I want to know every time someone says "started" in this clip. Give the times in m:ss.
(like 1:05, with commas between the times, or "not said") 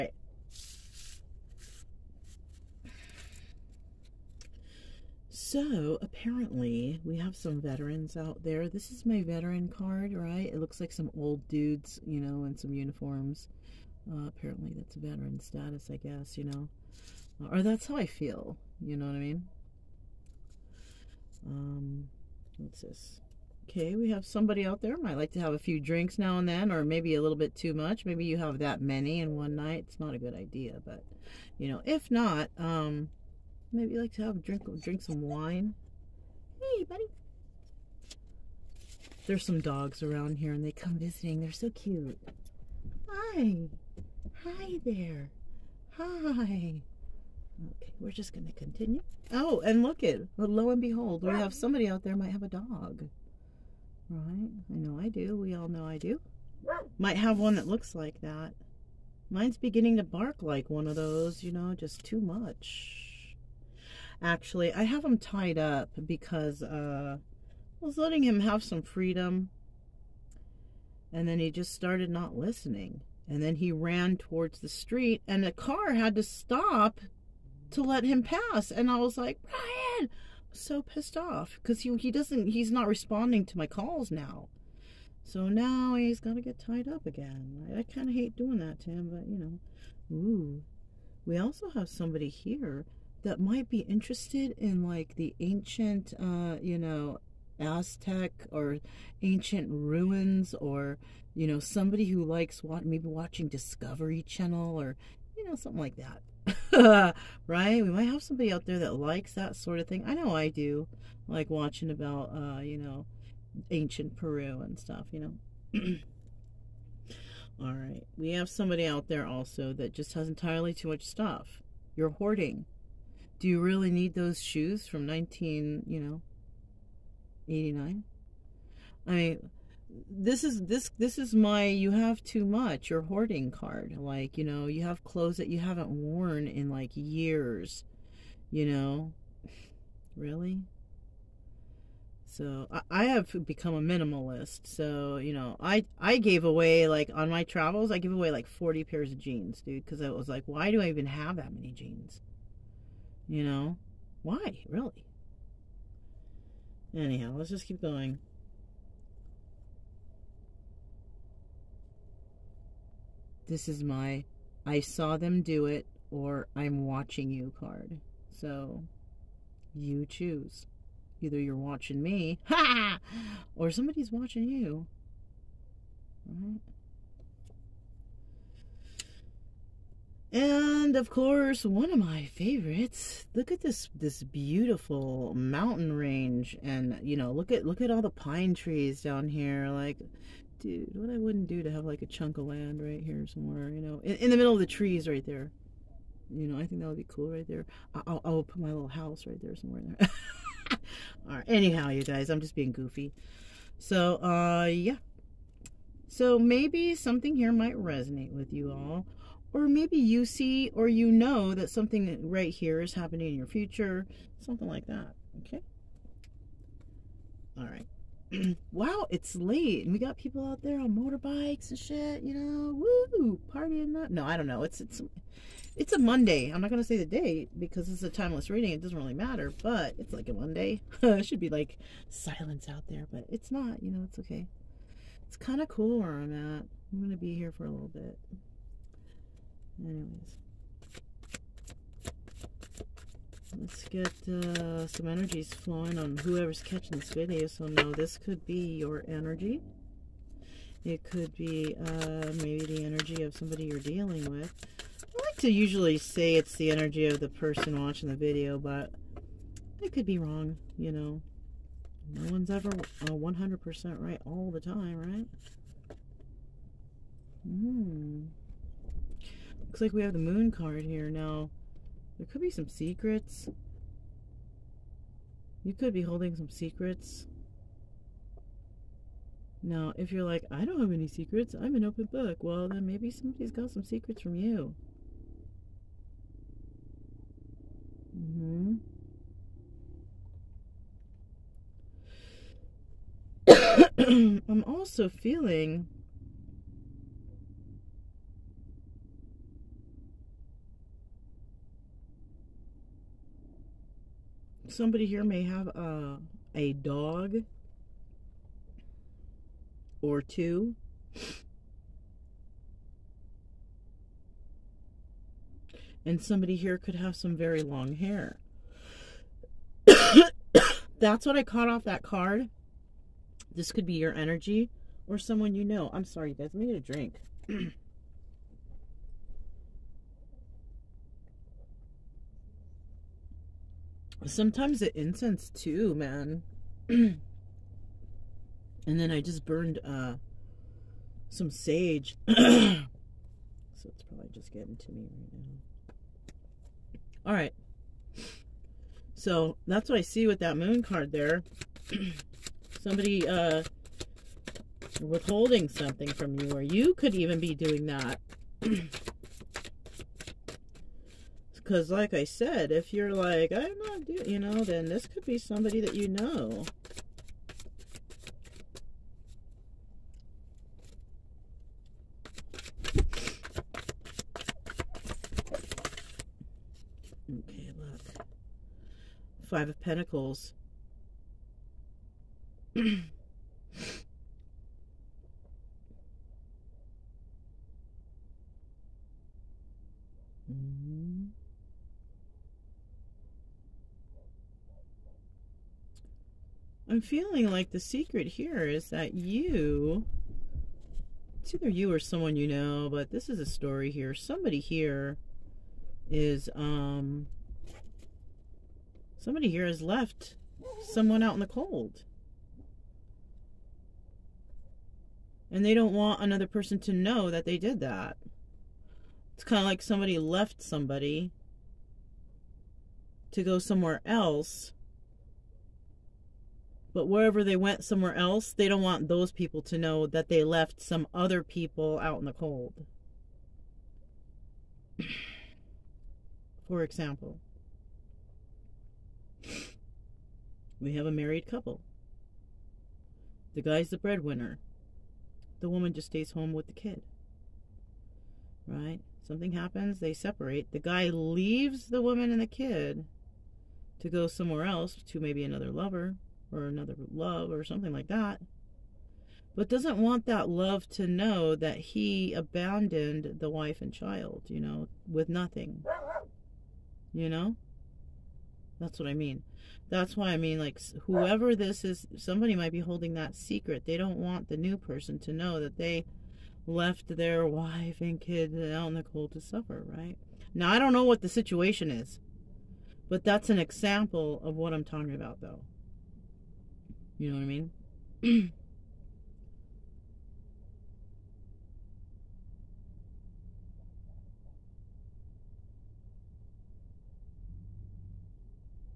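1:11.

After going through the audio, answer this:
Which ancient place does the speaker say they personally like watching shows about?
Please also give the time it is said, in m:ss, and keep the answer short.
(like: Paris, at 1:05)
Peru, at 1:53.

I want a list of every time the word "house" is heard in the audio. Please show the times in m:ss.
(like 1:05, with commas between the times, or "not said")
3:18.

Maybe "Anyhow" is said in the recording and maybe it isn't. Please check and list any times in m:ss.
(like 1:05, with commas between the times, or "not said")
2:36, 3:21.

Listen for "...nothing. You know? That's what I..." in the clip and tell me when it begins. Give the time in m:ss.
7:45.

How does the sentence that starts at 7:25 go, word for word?
The woman just stays home with the kid.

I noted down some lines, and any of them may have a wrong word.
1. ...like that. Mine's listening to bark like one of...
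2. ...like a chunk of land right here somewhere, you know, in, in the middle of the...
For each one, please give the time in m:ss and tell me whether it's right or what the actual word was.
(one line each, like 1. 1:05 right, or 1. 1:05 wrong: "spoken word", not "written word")
1. 0:57 wrong: "beginning", not "listening"
2. 3:11 right.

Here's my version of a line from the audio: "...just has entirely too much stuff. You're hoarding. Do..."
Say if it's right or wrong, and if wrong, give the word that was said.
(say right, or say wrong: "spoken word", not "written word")
right.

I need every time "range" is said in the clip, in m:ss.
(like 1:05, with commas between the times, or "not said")
3:05.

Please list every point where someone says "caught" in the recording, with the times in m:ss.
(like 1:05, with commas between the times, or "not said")
5:21.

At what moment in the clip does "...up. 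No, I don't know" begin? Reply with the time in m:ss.
3:43.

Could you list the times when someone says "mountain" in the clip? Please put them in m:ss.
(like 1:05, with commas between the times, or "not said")
3:05.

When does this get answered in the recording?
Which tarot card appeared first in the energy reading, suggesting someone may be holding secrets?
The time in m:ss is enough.
4:30.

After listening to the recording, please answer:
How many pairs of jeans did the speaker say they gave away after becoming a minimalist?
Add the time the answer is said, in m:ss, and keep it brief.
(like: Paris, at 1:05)
40, at 2:28.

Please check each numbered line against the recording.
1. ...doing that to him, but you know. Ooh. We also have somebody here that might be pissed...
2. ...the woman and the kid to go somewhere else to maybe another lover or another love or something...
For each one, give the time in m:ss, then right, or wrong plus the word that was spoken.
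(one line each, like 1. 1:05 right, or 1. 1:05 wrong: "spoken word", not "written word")
1. 1:28 wrong: "interested", not "pissed"
2. 7:31 right.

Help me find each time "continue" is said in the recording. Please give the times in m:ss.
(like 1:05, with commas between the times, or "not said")
0:48.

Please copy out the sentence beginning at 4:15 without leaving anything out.
I like to usually say it's the energy of the person watching the video, but it could be wrong, you know.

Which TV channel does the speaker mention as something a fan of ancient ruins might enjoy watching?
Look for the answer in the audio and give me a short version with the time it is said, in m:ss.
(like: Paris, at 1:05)
Discovery Channel, at 1:43.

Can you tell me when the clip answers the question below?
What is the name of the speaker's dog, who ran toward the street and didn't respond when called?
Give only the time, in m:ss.
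1:19.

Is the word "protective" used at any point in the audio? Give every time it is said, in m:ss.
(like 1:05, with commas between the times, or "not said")
not said.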